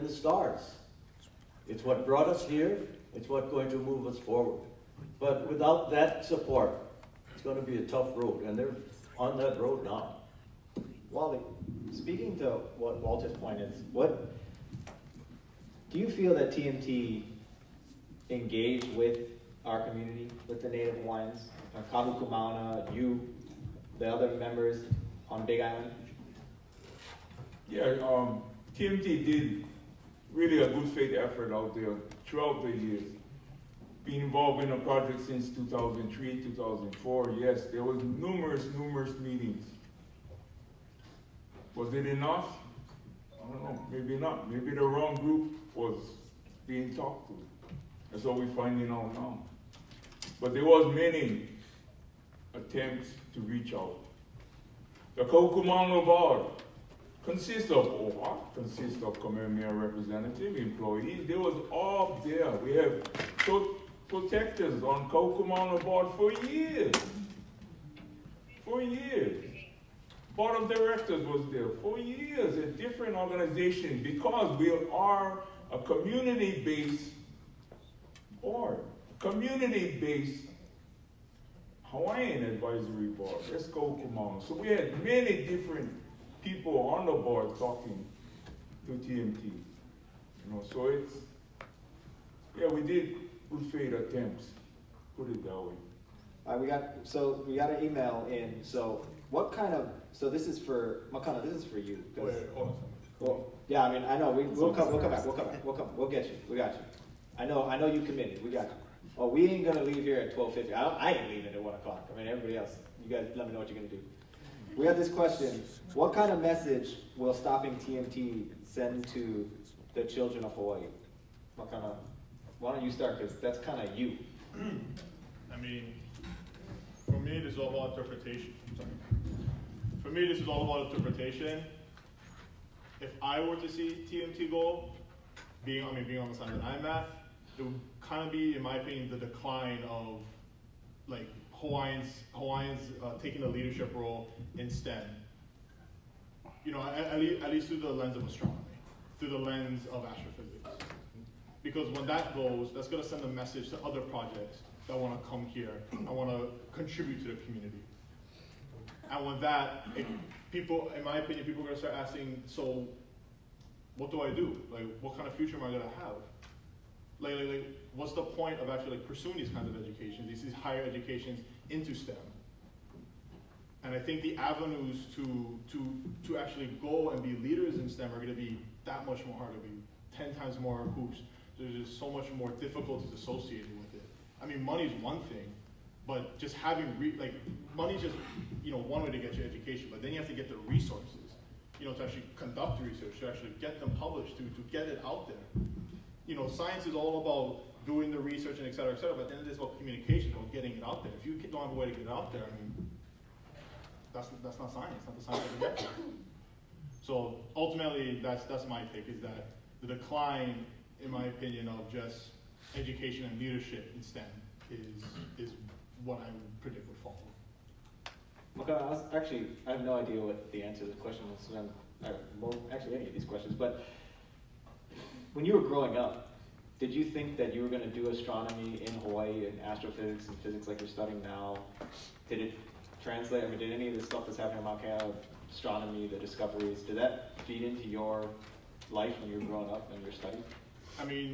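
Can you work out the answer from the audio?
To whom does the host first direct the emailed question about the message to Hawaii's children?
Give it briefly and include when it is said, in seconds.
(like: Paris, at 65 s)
Makana, at 101 s.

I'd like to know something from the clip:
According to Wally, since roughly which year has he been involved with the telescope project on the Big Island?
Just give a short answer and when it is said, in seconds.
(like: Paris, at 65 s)
2003, at 35 s.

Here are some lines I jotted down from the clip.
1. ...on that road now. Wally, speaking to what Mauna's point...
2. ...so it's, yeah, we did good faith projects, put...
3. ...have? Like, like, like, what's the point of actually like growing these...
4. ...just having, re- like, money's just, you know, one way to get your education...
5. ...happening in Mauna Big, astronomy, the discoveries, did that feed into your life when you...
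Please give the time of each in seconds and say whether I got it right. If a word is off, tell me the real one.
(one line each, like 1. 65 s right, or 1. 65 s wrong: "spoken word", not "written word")
1. 9 s wrong: "Walter", not "Mauna"
2. 90 s wrong: "attempts", not "projects"
3. 165 s wrong: "pursuing", not "growing"
4. 186 s right
5. 234 s wrong: "Kea", not "Big".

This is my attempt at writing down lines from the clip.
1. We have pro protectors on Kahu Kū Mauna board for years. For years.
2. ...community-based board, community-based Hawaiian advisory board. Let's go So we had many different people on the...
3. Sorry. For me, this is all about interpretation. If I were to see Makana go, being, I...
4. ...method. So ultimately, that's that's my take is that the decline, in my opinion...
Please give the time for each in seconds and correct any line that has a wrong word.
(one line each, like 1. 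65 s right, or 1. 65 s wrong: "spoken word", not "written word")
1. 62 s right
2. 75 s right
3. 128 s wrong: "TMT", not "Makana"
4. 205 s right.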